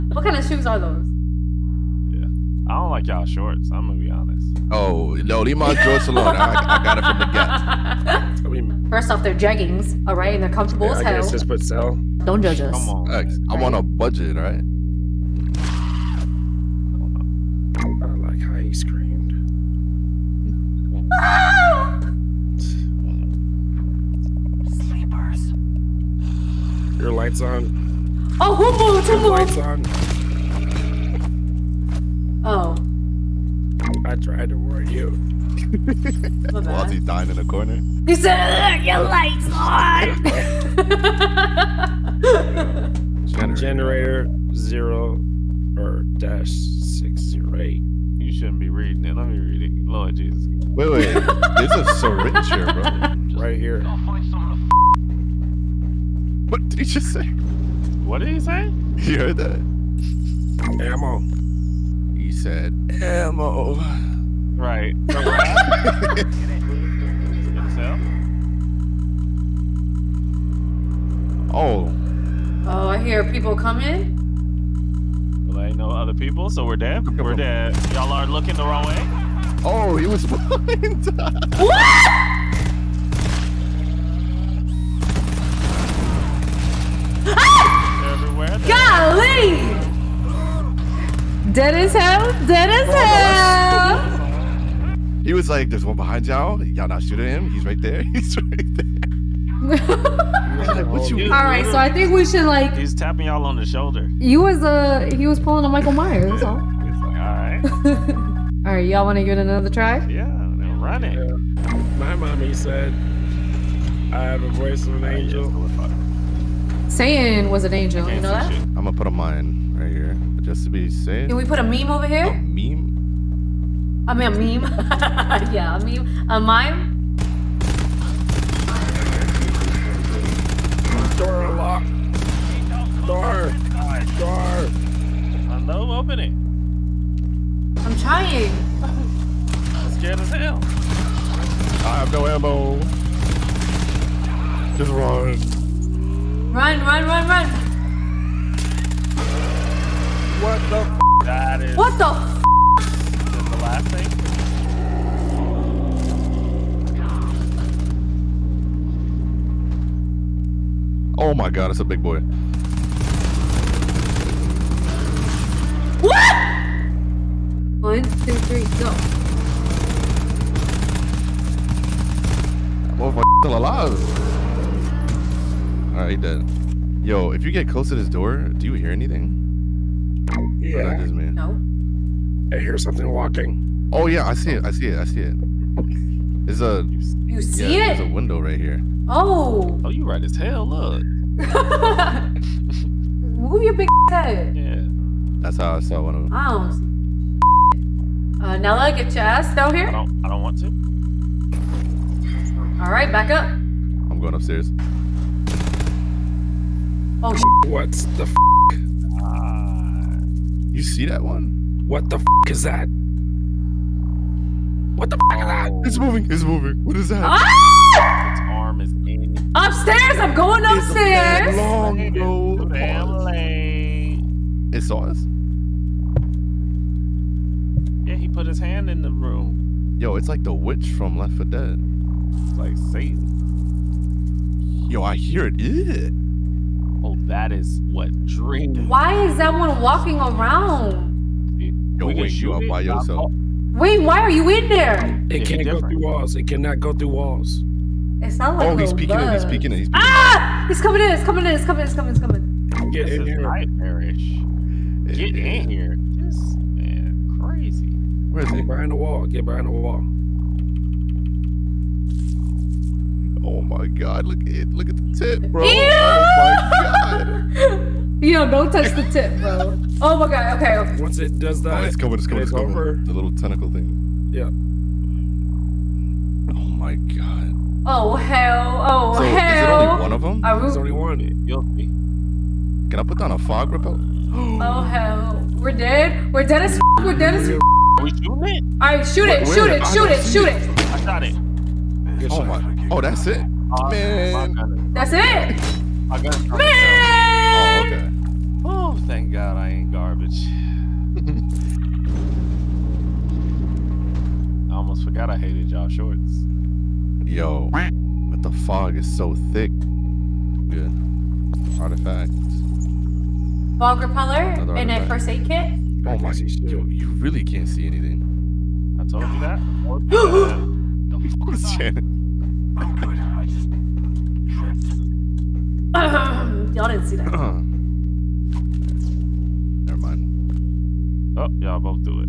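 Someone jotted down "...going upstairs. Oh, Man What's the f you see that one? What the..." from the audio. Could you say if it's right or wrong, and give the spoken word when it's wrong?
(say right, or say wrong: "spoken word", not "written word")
wrong: "What", not "Man".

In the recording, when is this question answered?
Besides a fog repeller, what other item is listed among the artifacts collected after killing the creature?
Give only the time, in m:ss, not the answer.
5:15.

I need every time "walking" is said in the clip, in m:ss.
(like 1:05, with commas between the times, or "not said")
3:03, 3:59.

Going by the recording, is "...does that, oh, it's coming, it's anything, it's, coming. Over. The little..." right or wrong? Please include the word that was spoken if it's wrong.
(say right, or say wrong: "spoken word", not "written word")
wrong: "coming", not "anything".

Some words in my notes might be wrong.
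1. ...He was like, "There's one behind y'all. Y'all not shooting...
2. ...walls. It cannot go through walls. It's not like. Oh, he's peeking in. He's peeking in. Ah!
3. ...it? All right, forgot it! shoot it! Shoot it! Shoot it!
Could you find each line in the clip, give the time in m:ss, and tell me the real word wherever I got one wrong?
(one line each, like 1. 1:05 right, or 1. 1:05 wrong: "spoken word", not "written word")
1. 1:35 right
2. 4:05 right
3. 4:48 wrong: "shoot", not "forgot".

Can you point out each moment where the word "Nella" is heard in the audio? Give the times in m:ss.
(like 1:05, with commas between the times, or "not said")
3:18.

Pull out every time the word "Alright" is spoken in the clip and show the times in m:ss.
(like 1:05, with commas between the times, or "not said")
2:55.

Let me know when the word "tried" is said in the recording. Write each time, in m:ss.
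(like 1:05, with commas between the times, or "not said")
0:34.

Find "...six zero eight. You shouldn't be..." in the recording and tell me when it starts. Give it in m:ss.
0:46.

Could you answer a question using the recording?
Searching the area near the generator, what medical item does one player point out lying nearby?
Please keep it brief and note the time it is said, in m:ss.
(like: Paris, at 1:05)
Syringe, at 0:51.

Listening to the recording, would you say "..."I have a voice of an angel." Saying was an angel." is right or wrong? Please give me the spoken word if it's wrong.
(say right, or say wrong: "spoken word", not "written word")
right.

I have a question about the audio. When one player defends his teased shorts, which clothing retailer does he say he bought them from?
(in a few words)
Gap.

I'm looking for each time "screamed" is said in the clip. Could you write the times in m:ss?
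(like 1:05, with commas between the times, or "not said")
0:18.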